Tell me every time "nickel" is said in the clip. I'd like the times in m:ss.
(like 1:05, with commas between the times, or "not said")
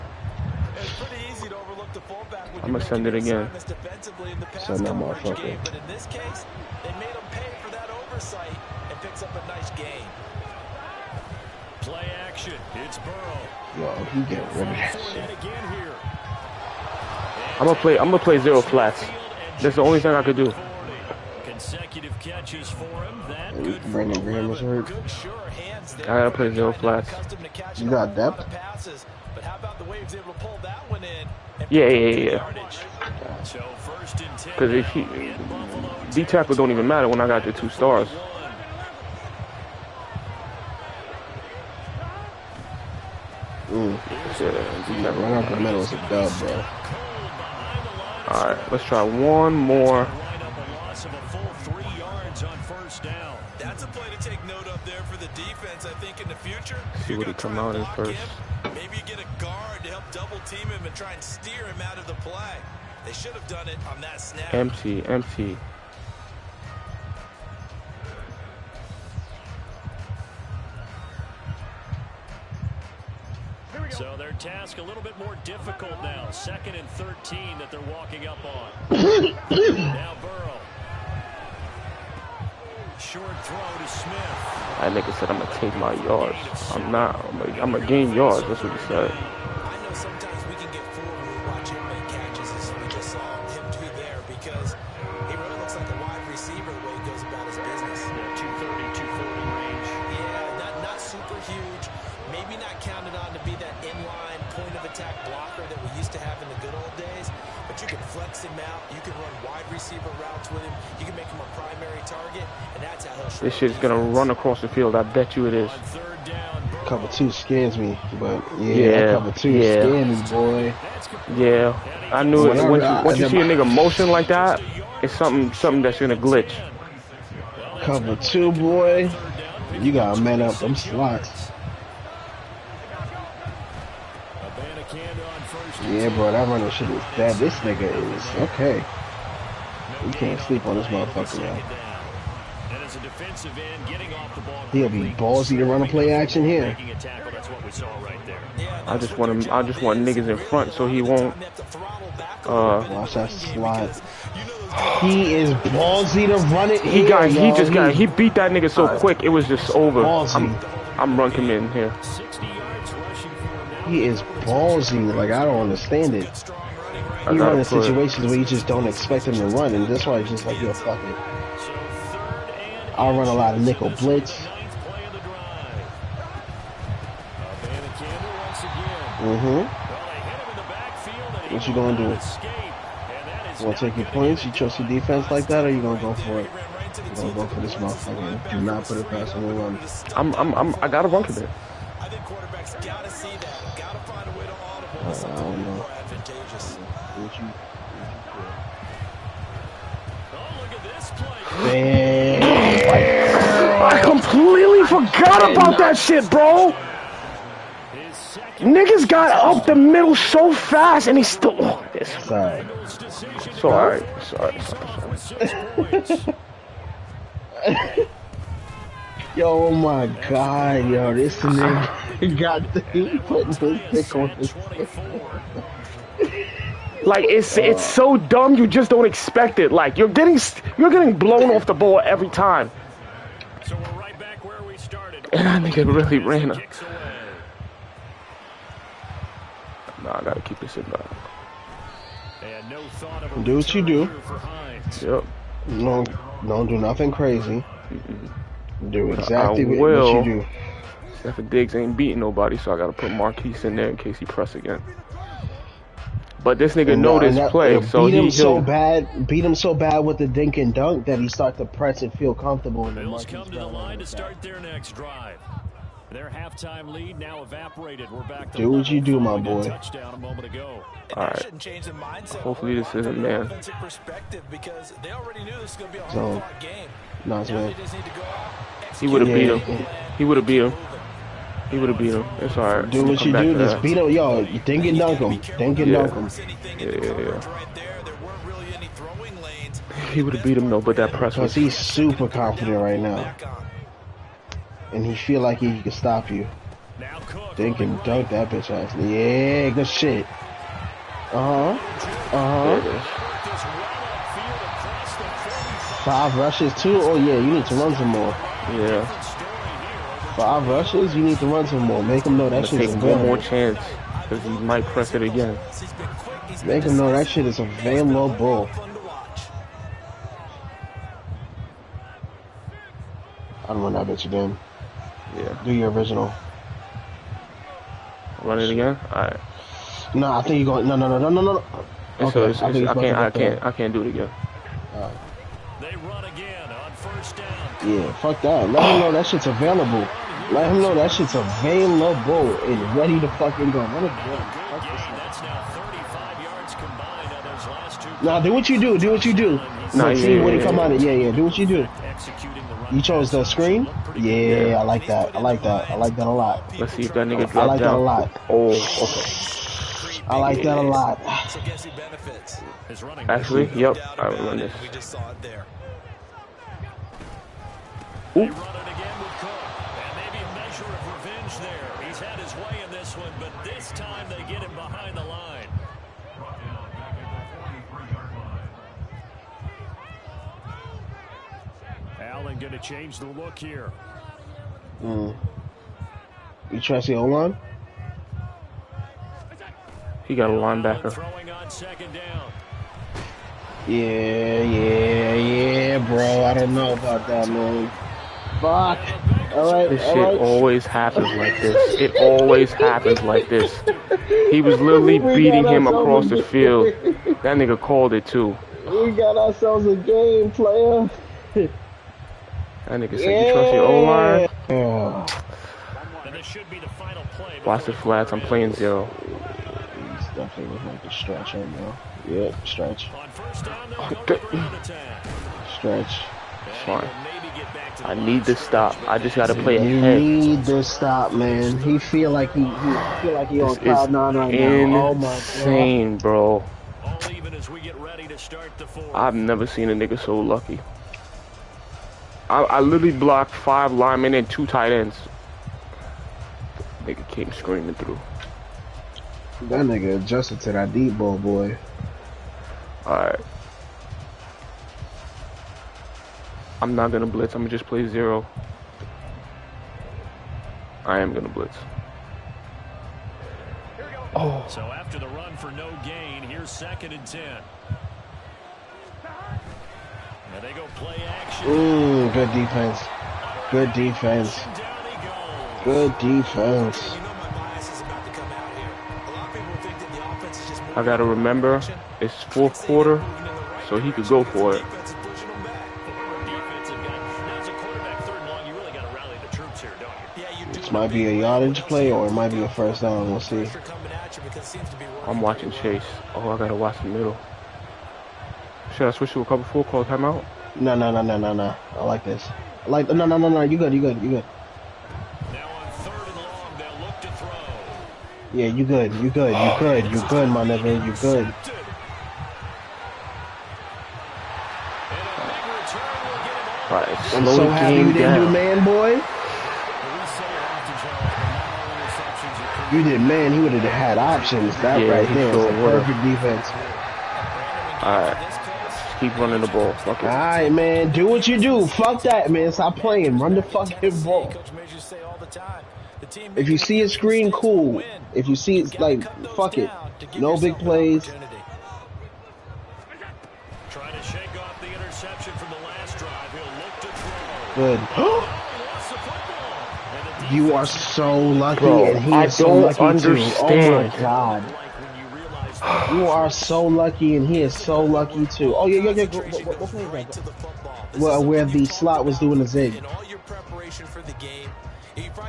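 2:53.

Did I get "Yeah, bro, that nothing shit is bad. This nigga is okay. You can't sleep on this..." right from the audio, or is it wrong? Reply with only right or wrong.
wrong.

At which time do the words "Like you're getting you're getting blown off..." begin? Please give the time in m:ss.
3:49.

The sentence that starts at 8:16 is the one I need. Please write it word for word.
Oh, I gotta watch the middle.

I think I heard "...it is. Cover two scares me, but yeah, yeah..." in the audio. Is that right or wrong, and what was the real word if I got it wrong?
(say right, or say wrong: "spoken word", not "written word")
right.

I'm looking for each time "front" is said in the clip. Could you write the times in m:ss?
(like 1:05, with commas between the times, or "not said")
2:30.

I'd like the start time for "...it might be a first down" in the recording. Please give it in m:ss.
8:12.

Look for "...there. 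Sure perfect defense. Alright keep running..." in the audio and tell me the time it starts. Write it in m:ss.
8:45.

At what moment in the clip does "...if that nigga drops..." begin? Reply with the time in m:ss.
5:57.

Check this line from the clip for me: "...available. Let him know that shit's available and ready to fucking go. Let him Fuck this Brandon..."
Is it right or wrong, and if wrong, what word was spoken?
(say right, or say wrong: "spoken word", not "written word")
wrong: "Nah", not "Brandon".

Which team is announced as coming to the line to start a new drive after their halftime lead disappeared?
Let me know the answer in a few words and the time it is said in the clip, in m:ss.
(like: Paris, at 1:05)
Bills, at 4:23.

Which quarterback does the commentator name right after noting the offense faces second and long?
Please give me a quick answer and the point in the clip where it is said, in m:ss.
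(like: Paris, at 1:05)
Burrow, at 1:20.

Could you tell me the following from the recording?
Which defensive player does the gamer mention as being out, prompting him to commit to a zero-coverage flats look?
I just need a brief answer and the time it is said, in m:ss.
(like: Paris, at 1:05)
Brandon Graham, at 0:23.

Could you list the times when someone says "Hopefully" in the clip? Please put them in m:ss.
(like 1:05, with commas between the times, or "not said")
4:32.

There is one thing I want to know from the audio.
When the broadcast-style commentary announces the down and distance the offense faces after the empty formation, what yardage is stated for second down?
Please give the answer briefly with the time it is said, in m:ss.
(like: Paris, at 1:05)
13, at 1:16.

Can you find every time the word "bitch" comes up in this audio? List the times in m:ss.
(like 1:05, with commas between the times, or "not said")
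4:58, 5:24.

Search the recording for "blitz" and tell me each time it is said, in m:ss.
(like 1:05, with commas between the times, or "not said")
2:53, 7:37, 7:41.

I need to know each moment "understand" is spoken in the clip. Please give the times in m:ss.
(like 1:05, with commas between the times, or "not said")
2:45, 9:13.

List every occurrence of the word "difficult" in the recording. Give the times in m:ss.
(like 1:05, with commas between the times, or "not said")
1:15.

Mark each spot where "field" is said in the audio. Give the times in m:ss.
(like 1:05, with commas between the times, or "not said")
1:54, 6:46.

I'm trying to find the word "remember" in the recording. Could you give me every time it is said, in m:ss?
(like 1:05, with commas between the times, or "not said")
6:04, 8:01.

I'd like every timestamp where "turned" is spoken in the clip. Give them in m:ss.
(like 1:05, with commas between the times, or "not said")
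not said.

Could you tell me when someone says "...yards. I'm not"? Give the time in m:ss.
1:26.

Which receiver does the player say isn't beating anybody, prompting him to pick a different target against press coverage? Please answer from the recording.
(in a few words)
Stefon Diggs.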